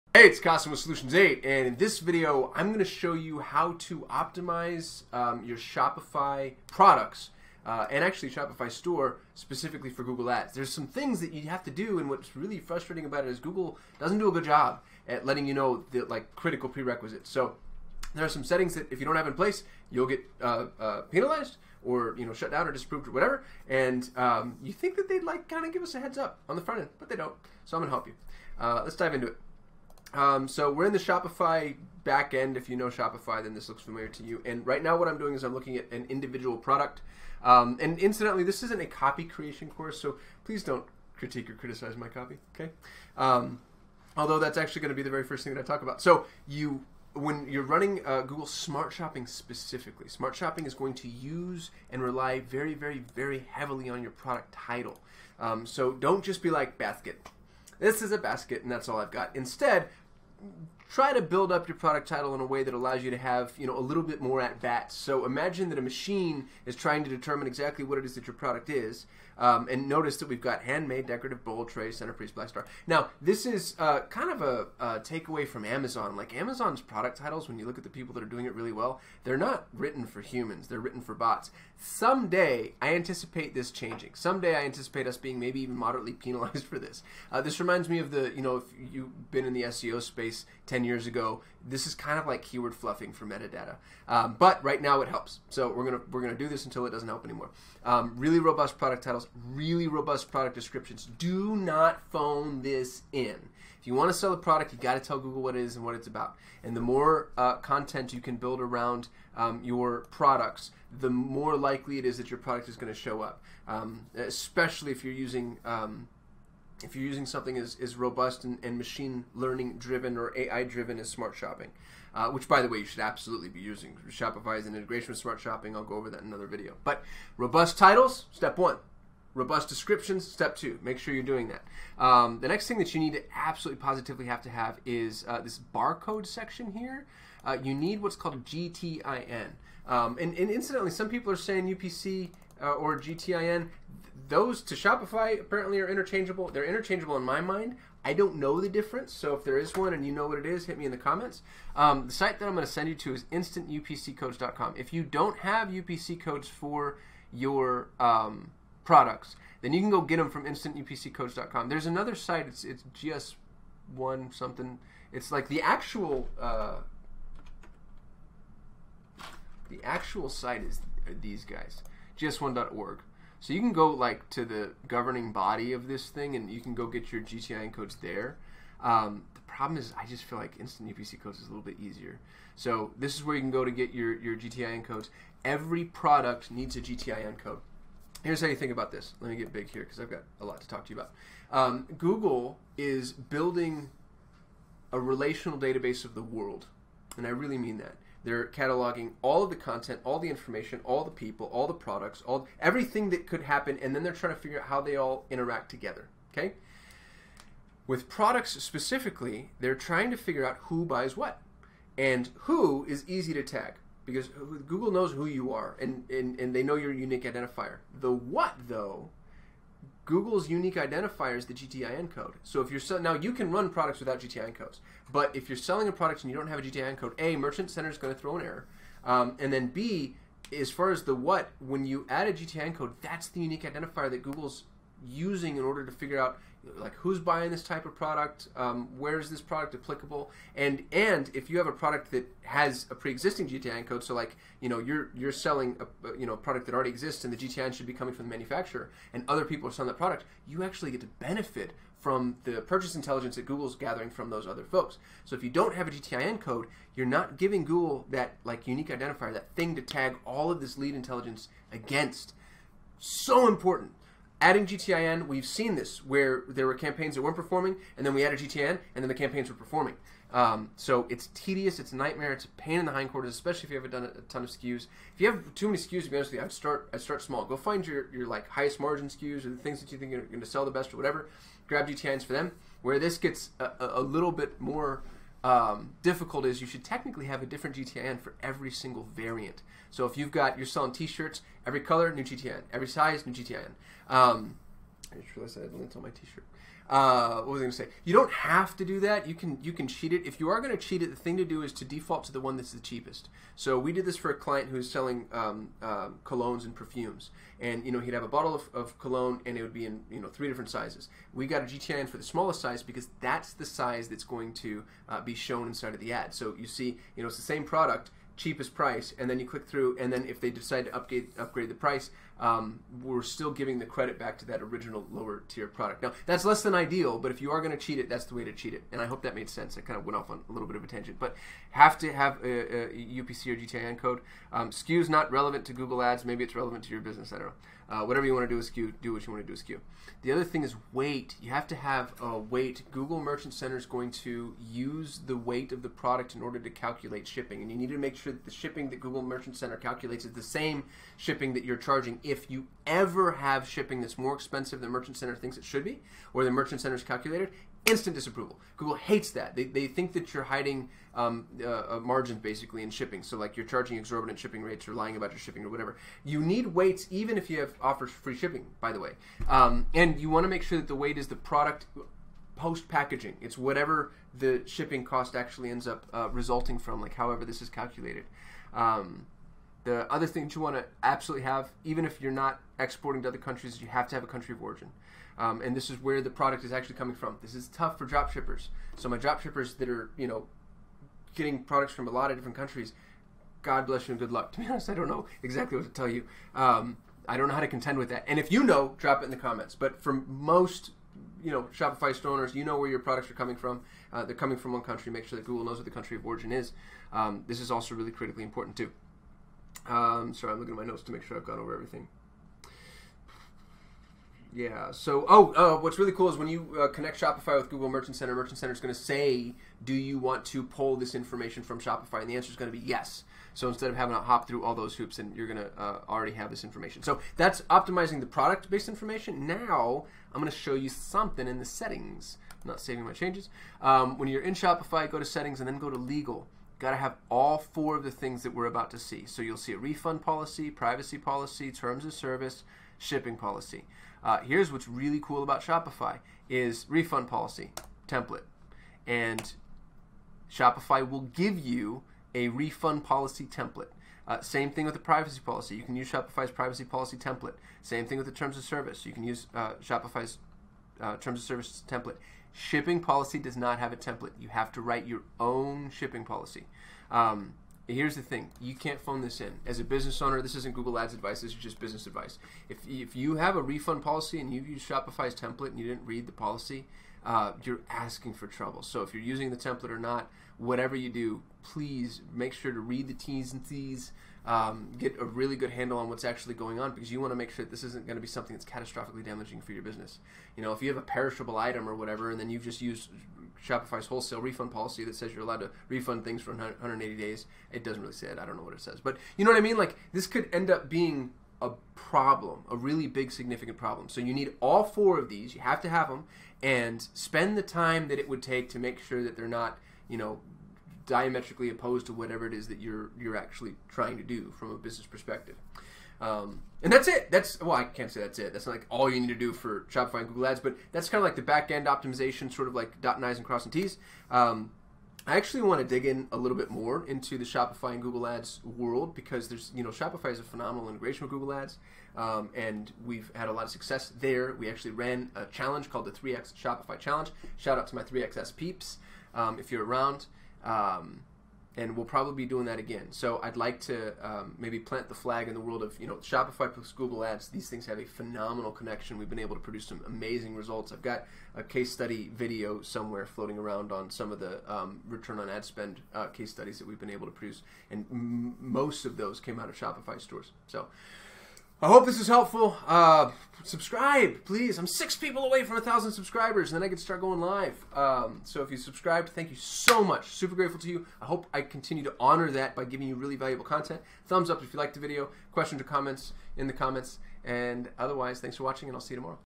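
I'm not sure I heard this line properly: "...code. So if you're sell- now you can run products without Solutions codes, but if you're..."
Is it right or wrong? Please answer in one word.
wrong.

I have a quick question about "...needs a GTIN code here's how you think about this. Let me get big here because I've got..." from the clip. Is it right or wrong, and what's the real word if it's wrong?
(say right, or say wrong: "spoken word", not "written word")
right.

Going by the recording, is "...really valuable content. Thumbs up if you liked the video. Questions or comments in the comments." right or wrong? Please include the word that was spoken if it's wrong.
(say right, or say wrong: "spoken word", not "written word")
right.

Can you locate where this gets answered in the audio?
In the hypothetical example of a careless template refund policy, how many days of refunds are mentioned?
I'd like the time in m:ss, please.
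8:16.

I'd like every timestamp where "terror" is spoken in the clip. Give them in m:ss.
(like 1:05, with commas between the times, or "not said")
not said.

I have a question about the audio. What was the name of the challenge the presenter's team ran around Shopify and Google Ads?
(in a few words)
3x Shopify Challenge.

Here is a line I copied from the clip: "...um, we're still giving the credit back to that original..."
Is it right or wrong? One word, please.
right.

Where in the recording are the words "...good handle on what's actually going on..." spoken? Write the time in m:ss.
8:05.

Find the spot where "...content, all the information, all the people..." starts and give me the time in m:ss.
3:19.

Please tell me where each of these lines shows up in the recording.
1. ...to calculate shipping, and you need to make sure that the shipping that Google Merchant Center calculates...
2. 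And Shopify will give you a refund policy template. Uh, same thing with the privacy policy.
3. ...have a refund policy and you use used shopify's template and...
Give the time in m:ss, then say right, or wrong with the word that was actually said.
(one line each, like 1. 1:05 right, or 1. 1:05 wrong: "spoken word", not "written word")
1. 5:46 right
2. 7:29 right
3. 7:53 right.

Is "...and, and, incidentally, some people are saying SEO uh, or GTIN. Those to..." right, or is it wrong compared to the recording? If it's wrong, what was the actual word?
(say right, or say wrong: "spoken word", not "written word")
wrong: "UPC", not "SEO".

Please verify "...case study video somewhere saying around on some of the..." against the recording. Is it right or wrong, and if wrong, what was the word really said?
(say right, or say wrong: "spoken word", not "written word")
wrong: "floating", not "saying".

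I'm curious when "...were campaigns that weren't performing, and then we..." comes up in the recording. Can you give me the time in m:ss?
4:26.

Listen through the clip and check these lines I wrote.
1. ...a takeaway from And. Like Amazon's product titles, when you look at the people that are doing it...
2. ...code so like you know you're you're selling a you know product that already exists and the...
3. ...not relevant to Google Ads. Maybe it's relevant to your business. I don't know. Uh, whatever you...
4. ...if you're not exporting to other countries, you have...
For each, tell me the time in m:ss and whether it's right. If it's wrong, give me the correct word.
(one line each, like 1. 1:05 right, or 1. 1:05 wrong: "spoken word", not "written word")
1. 1:14 wrong: "Amazon", not "And"
2. 4:03 right
3. 5:35 right
4. 6:22 right.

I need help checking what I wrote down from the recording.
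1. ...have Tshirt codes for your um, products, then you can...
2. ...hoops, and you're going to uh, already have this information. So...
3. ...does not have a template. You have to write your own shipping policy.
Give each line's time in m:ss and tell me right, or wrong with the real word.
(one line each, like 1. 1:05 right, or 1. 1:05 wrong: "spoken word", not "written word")
1. 2:35 wrong: "UPC", not "Tshirt"
2. 7:04 right
3. 7:43 right.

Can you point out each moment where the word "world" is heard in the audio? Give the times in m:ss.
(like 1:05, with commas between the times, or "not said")
3:16, 8:48, 9:05.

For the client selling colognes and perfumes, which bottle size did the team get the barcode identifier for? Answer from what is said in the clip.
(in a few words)
the smallest size.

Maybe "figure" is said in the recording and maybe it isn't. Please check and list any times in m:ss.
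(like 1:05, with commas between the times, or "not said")
3:24, 3:30, 3:55.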